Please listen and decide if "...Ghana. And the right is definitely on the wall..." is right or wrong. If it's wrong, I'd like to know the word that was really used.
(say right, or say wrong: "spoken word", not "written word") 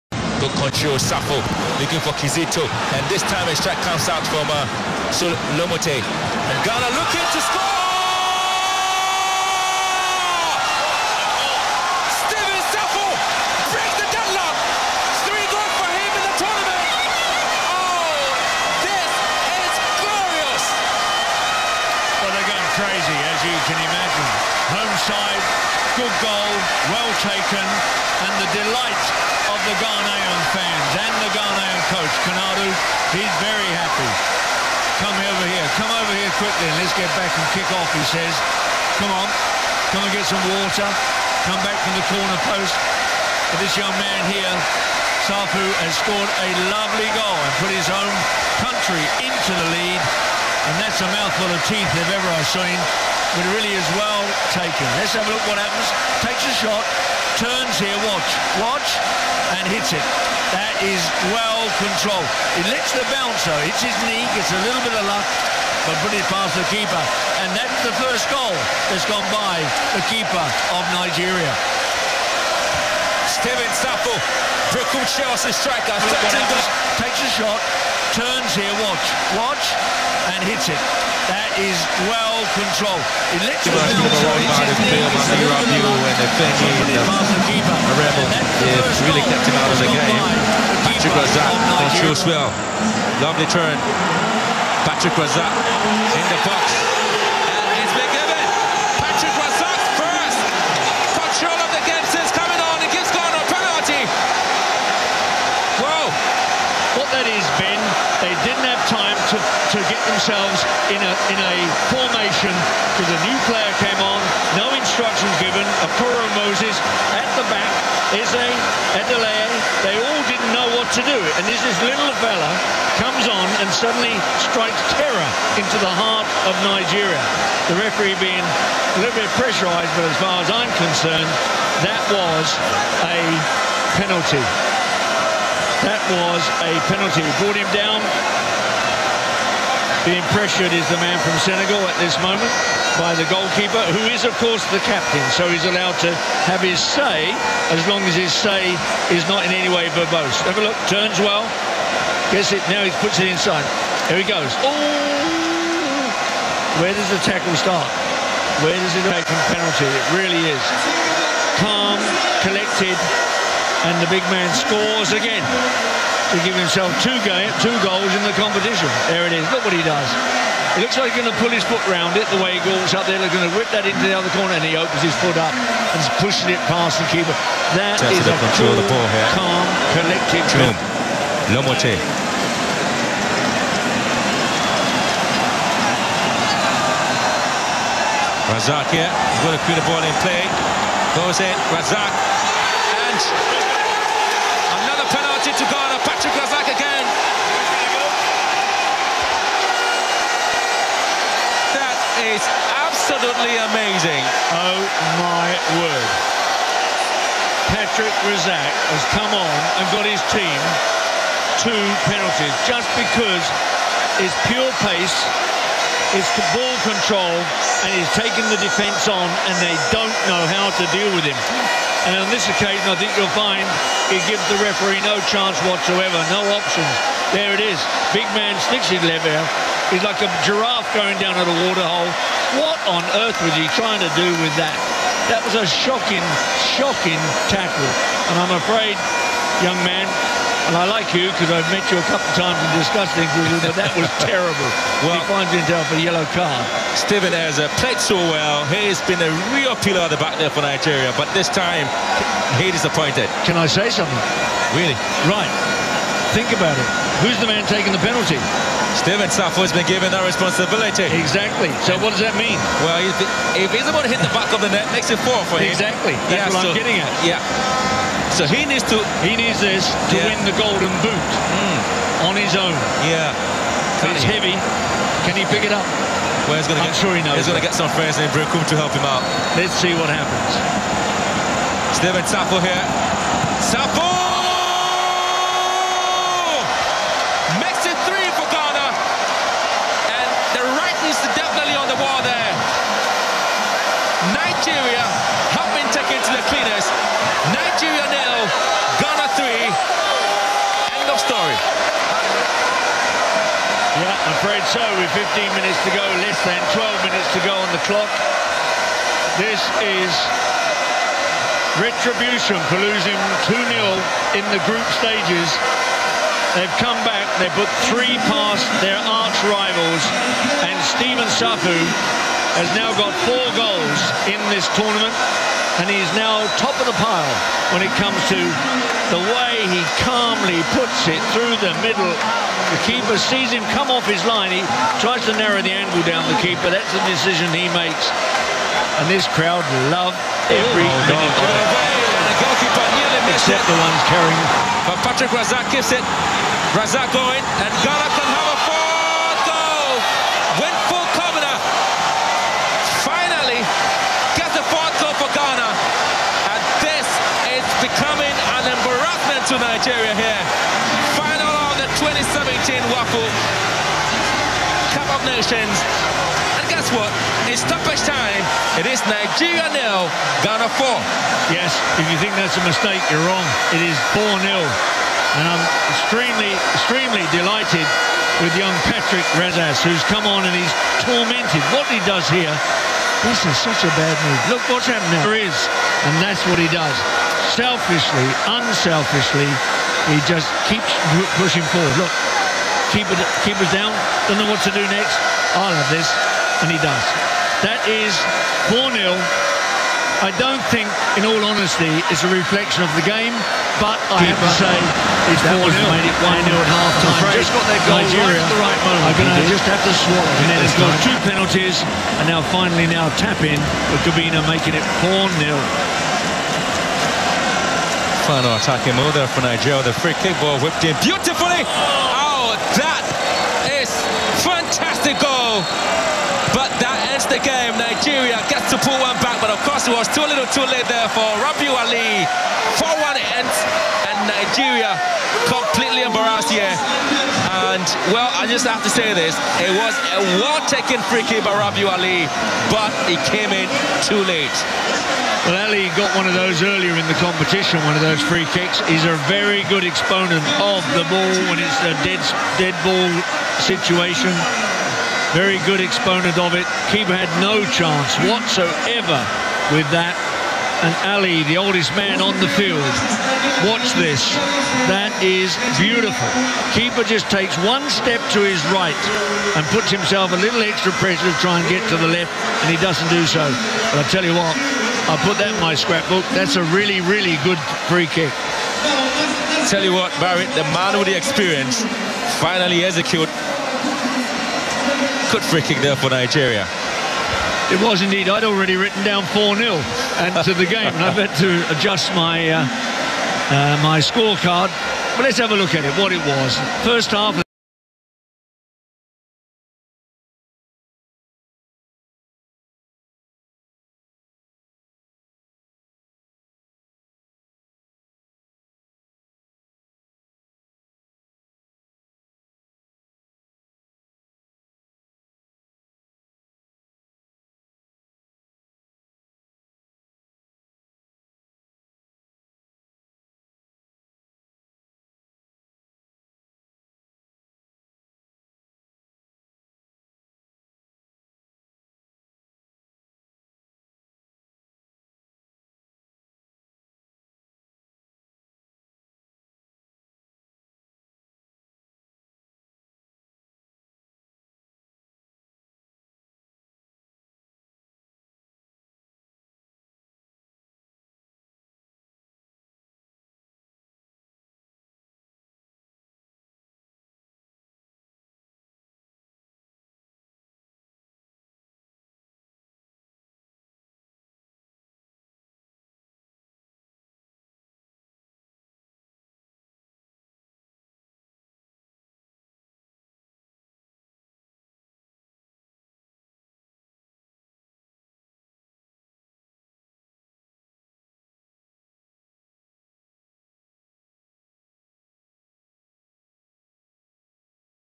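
right.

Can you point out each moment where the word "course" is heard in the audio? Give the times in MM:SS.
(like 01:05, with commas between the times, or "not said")
02:24, 07:09.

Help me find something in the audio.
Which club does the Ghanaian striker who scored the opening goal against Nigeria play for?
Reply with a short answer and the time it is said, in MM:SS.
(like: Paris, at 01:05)
Berekum Chelsea, at 01:14.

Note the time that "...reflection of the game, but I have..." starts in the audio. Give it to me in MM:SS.
06:42.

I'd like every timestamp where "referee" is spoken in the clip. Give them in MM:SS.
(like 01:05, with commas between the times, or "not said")
02:07, 03:44.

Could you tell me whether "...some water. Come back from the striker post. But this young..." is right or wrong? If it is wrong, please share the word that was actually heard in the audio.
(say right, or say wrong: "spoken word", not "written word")
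wrong: "corner", not "striker".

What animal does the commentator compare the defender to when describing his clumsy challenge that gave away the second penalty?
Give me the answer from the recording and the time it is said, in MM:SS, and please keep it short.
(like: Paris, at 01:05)
giraffe, at 03:50.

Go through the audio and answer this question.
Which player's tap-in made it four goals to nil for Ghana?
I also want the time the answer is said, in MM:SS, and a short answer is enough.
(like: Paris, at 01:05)
Cobbinah, at 06:54.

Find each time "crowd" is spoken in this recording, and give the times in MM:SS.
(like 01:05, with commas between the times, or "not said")
05:39.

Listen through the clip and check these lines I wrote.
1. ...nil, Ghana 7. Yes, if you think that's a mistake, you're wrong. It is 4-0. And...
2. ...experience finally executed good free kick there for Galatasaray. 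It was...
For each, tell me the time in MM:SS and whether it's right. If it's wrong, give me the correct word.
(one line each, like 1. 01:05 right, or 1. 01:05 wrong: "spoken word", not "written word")
1. 06:09 wrong: "4", not "7"
2. 08:01 wrong: "Nigeria", not "Galatasaray".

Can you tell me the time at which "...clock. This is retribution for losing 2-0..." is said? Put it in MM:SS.
05:07.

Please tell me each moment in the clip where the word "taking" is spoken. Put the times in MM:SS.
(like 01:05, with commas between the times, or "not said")
03:38, 04:17.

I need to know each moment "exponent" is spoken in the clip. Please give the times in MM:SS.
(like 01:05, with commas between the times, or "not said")
07:29, 07:35.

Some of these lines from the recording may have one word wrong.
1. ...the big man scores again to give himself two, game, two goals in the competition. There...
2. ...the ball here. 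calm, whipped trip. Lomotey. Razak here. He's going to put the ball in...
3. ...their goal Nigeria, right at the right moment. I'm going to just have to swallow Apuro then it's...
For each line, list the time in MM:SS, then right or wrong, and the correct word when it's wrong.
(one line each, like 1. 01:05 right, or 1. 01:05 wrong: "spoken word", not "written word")
1. 02:44 right
2. 02:58 wrong: "collected", not "whipped"
3. 06:47 wrong: "And", not "Apuro".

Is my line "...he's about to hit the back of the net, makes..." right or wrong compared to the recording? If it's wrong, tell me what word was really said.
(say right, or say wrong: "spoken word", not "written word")
right.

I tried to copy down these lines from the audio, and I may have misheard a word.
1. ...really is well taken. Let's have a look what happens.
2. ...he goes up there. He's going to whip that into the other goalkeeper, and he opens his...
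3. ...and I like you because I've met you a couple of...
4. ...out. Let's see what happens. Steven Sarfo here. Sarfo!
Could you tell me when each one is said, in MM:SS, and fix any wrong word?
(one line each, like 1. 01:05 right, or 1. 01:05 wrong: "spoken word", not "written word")
1. 00:53 right
2. 02:52 wrong: "corner", not "goalkeeper"
3. 04:00 right
4. 04:39 right.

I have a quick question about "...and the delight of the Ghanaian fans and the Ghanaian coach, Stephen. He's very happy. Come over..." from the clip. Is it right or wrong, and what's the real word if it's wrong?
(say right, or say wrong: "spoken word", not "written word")
wrong: "Konadu", not "Stephen".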